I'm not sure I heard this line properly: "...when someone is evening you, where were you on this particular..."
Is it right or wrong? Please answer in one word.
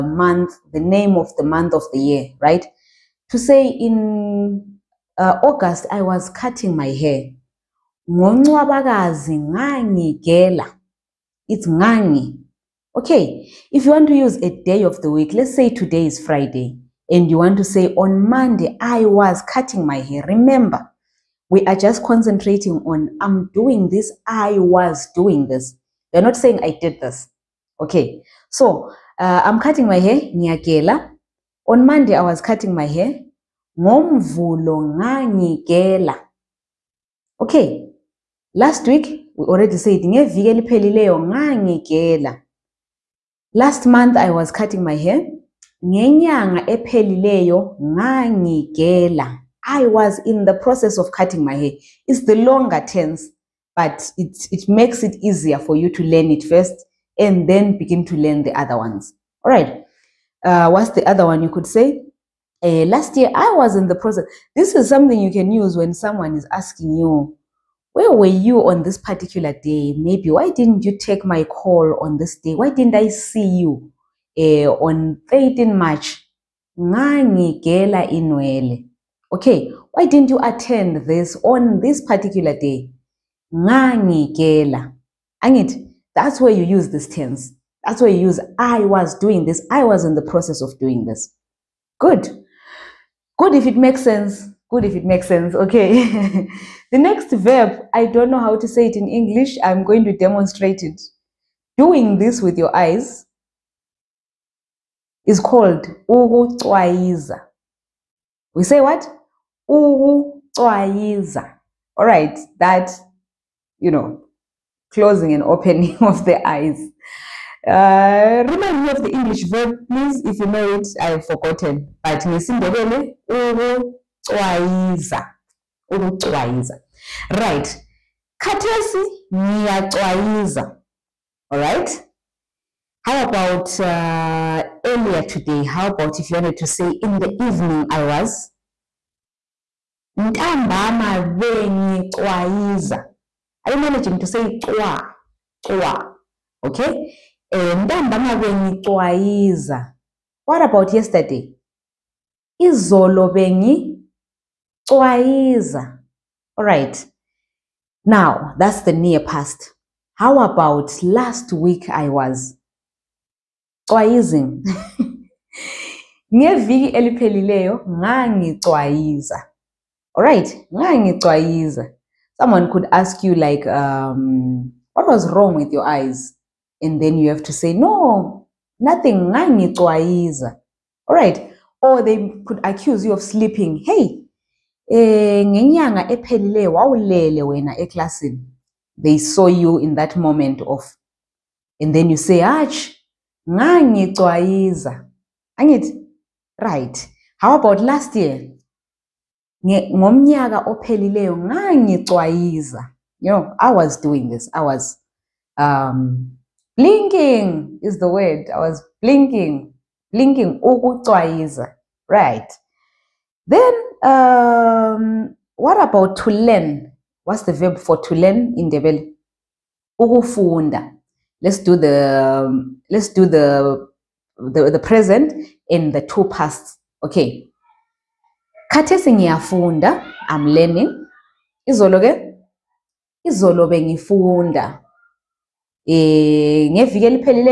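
wrong.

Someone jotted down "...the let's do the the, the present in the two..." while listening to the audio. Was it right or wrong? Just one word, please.
right.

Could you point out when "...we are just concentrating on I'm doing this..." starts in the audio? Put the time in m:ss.
0:21.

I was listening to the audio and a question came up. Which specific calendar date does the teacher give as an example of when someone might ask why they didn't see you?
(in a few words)
13 March.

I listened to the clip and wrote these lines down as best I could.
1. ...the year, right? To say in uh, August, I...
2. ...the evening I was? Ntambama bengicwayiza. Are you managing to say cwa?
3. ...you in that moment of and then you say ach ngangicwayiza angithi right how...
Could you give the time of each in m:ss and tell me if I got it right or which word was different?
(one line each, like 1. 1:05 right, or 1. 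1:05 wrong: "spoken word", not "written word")
1. 0:01 right
2. 2:17 right
3. 3:09 right.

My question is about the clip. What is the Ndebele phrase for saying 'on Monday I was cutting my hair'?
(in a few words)
Ngomvulo ngangigela.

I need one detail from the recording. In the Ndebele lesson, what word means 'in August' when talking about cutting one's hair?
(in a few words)
ngani.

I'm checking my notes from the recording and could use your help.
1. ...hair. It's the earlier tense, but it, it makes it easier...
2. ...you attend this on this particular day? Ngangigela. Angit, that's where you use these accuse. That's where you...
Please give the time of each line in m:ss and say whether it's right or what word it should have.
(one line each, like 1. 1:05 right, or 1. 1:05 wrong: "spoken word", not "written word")
1. 0:51 wrong: "longer", not "earlier"
2. 1:20 wrong: "tense", not "accuse".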